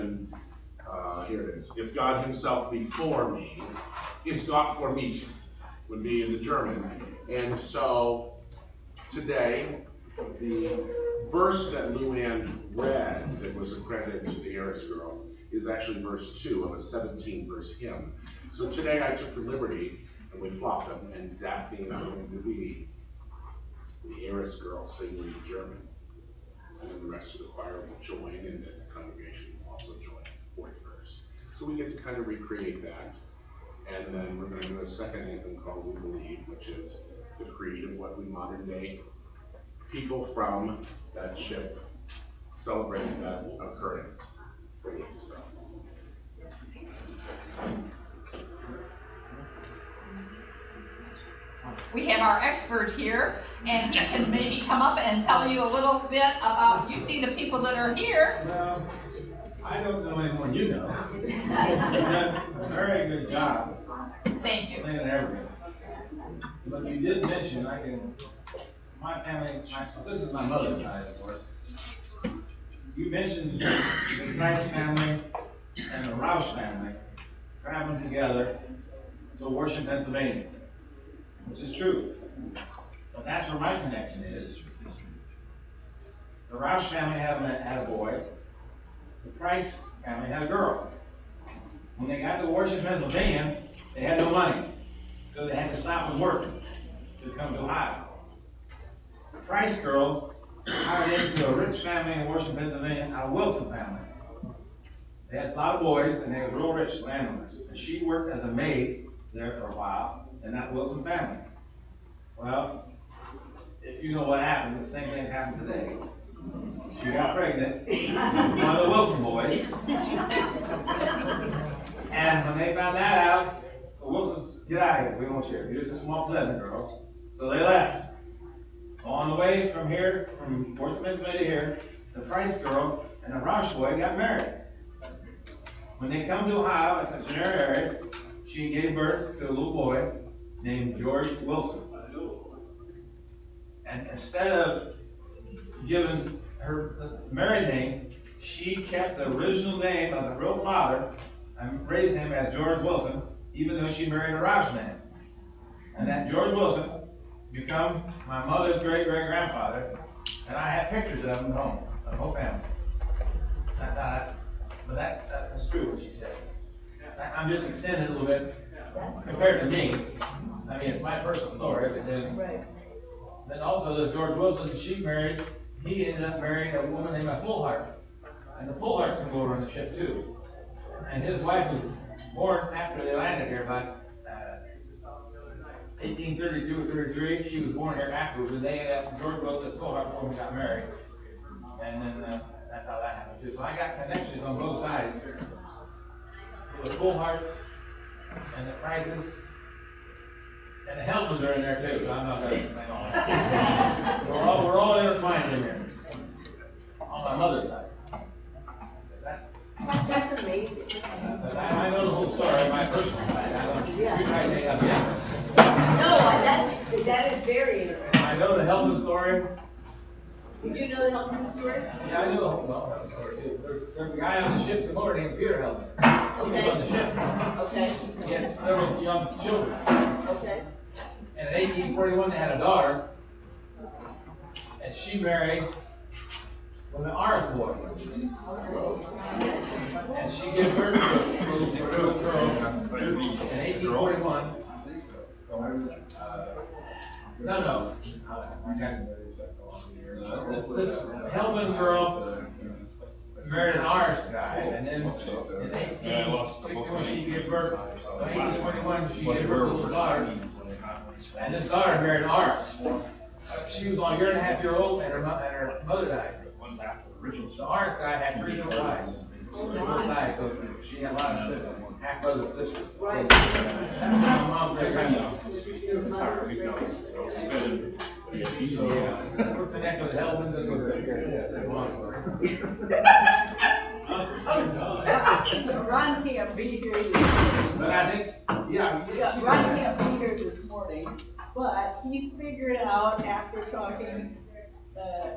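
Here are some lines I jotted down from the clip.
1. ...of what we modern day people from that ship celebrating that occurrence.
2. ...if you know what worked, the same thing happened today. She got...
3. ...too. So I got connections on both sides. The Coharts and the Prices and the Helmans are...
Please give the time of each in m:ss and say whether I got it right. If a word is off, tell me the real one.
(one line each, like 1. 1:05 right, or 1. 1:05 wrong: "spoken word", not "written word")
1. 0:37 right
2. 1:53 wrong: "happened", not "worked"
3. 3:13 right.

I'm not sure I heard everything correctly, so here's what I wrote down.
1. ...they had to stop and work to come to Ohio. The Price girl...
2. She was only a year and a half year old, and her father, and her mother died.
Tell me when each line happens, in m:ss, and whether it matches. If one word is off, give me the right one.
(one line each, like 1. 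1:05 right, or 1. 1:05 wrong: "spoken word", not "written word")
1. 1:35 right
2. 4:23 wrong: "mother", not "father".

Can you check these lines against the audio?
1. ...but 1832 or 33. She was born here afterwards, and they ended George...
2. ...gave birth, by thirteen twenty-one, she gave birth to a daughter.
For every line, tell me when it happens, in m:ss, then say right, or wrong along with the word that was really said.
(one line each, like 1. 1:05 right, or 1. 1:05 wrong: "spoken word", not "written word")
1. 3:03 right
2. 4:17 wrong: "eighteen", not "thirteen".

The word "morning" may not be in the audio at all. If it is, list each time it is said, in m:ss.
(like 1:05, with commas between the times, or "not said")
4:50.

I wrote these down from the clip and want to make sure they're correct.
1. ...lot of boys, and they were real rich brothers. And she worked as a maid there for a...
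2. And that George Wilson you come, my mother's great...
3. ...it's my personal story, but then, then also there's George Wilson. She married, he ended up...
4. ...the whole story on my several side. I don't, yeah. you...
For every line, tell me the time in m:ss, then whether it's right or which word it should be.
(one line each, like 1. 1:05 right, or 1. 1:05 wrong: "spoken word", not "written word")
1. 1:45 wrong: "landowners", not "brothers"
2. 2:35 right
3. 2:50 right
4. 3:32 wrong: "personal", not "several".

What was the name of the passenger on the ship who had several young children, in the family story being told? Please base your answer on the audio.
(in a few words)
Peter Helen.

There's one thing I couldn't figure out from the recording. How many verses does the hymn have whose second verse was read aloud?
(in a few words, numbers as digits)
17.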